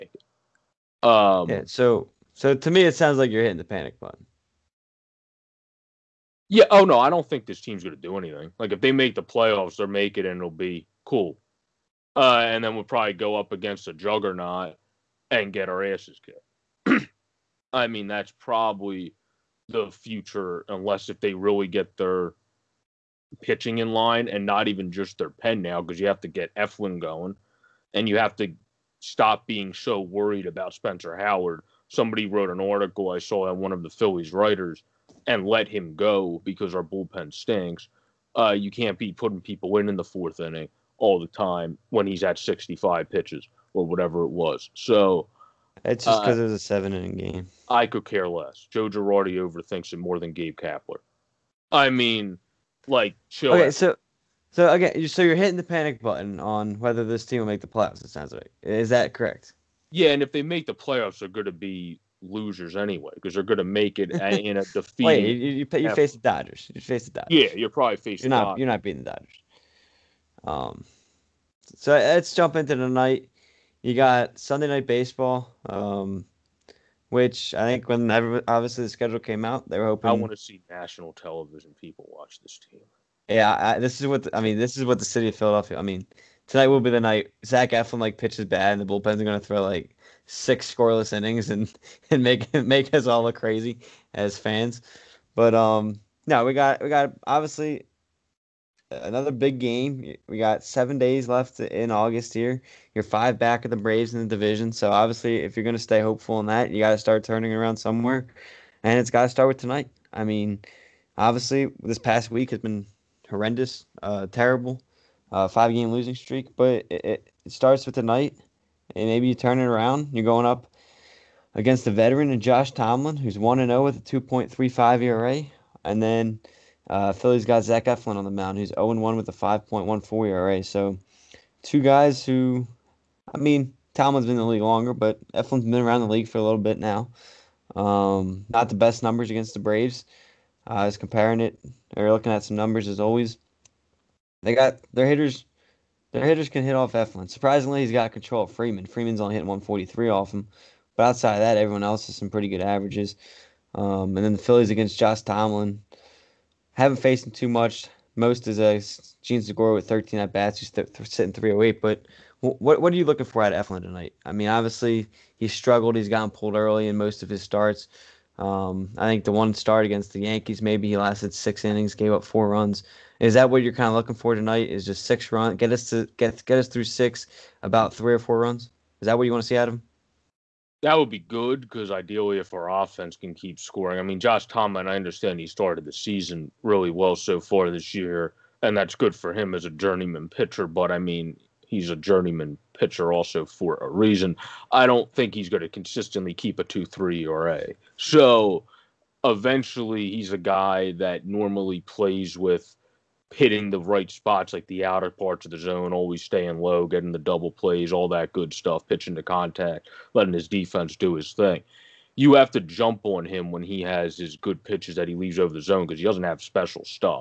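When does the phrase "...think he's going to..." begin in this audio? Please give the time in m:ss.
3:15.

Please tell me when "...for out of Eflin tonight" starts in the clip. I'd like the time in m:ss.
2:43.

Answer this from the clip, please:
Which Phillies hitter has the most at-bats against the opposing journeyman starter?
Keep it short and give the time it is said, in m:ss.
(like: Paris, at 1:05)
Jean Segura, at 2:39.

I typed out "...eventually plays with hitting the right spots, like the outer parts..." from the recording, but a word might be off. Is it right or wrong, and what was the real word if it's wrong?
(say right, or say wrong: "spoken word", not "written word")
wrong: "normally", not "eventually".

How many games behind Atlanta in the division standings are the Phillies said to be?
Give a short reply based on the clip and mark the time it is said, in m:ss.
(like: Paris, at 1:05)
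5, at 1:43.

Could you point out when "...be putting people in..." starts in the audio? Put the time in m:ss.
0:38.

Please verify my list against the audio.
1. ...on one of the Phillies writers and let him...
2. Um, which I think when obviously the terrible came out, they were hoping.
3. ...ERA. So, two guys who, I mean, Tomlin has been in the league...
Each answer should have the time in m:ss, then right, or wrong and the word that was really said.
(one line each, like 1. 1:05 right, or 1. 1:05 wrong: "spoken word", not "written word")
1. 0:33 right
2. 1:15 wrong: "schedule", not "terrible"
3. 2:10 right.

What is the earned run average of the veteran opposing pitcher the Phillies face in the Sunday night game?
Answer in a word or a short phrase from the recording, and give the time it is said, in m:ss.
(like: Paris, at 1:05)
2.35, at 2:03.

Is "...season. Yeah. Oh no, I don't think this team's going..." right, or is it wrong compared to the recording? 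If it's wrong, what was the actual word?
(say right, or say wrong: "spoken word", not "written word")
wrong: "button", not "season".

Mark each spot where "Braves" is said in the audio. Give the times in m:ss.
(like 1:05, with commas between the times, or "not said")
1:43, 2:19.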